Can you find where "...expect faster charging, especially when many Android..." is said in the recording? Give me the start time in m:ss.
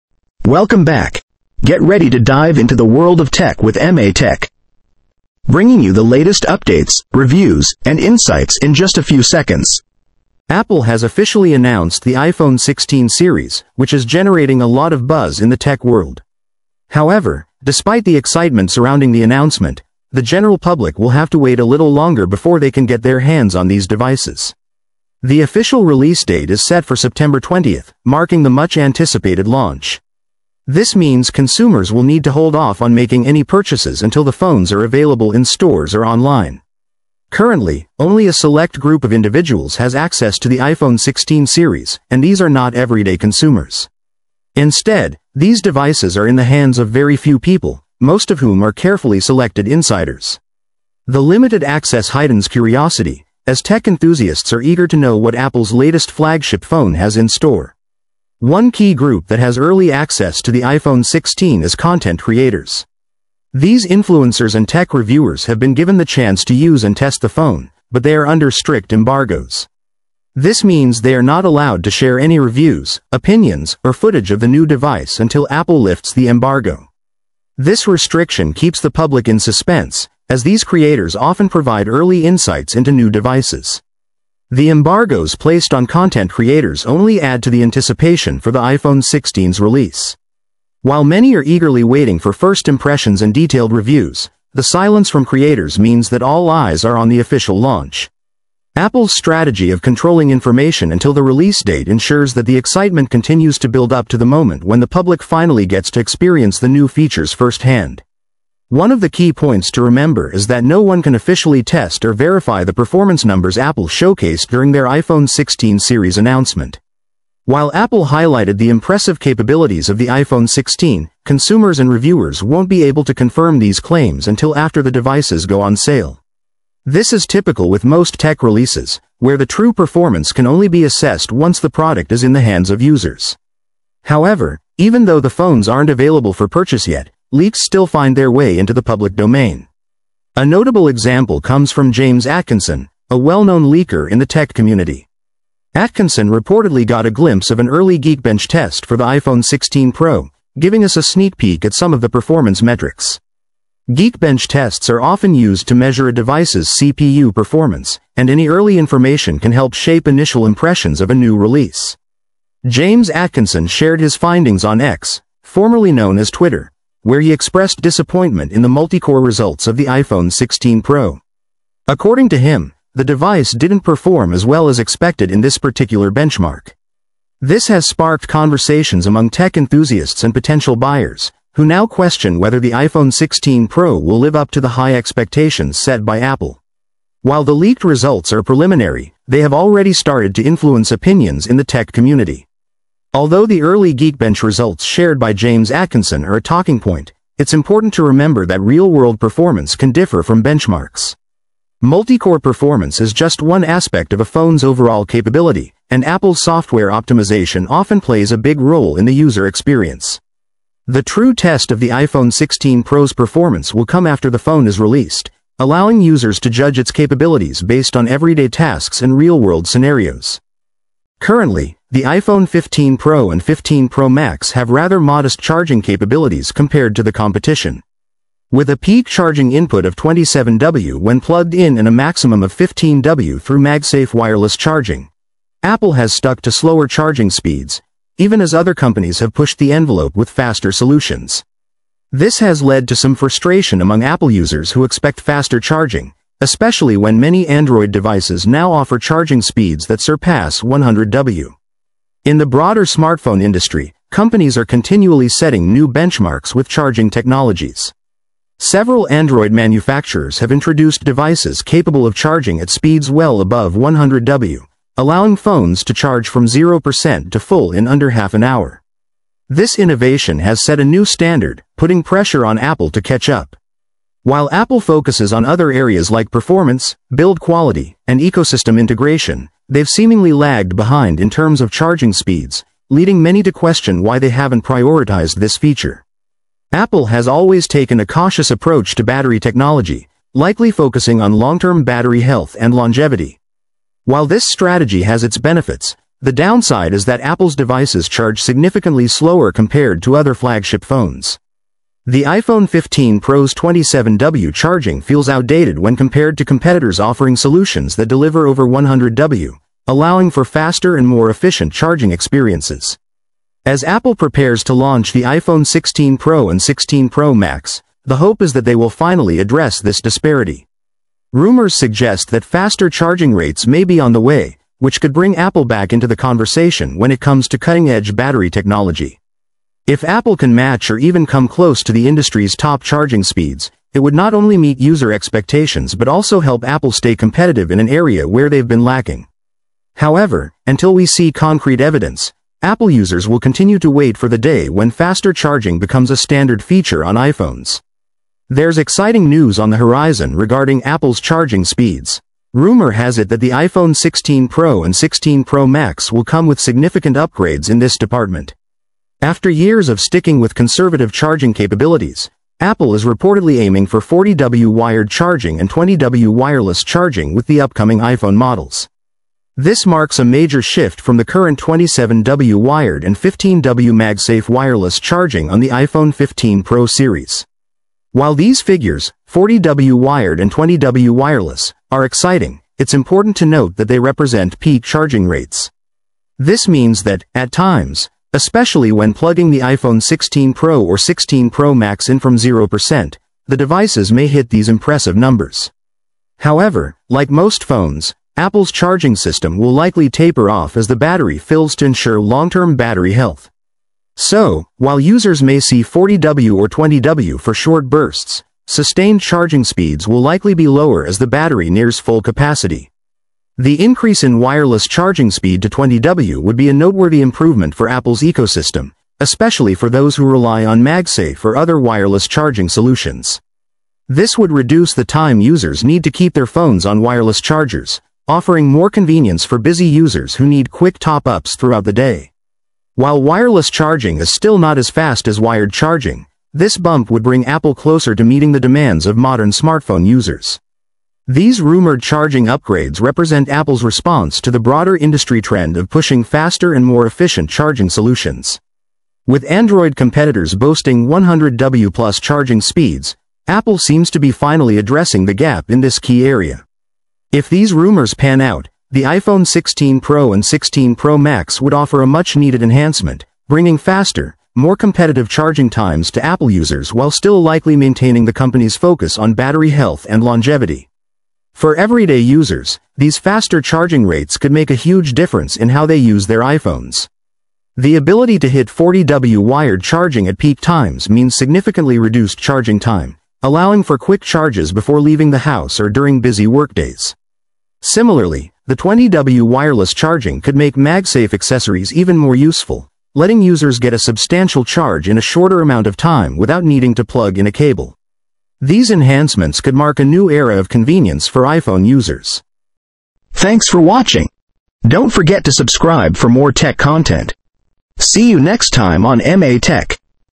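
4:04.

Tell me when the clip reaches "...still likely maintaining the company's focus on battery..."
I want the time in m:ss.
7:47.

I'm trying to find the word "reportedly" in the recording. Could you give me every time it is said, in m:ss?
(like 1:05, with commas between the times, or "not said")
2:26, 6:03.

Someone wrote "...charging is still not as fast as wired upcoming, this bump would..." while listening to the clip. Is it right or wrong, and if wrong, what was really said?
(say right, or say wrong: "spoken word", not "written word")
wrong: "charging", not "upcoming".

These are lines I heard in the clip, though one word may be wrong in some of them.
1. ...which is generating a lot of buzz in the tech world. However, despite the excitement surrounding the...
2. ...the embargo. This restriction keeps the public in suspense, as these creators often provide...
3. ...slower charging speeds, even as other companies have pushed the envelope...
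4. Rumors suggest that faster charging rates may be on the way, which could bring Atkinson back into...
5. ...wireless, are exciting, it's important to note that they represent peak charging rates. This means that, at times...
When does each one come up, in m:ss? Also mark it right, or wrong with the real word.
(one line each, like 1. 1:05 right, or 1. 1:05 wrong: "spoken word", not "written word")
1. 0:13 right
2. 1:16 right
3. 3:56 right
4. 5:21 wrong: "Apple", not "Atkinson"
5. 6:21 right.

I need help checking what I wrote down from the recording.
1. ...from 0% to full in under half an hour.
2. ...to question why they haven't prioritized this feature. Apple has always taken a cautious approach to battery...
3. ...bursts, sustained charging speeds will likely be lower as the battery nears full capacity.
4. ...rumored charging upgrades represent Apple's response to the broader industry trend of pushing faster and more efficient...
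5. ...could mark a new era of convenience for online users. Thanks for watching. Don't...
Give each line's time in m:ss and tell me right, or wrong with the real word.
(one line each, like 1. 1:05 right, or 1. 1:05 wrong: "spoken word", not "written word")
1. 4:26 right
2. 4:43 right
3. 6:47 right
4. 7:21 right
5. 8:19 wrong: "iPhone", not "online".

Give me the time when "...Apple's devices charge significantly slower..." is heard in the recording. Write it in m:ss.
4:57.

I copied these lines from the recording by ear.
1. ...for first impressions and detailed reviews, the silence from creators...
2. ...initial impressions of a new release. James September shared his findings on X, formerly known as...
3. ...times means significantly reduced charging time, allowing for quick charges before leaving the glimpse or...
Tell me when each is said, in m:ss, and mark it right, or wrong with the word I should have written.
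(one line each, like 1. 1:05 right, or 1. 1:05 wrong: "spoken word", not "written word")
1. 1:32 right
2. 2:40 wrong: "Atkinson", not "September"
3. 8:00 wrong: "house", not "glimpse".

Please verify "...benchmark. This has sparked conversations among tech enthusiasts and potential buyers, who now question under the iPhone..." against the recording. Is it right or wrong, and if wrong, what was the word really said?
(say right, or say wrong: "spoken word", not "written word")
wrong: "whether", not "under".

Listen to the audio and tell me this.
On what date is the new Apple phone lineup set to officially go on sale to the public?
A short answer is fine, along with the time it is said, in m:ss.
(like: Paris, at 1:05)
September 20th, at 0:26.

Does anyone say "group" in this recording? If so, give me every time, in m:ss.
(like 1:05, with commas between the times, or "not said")
0:38, 0:58.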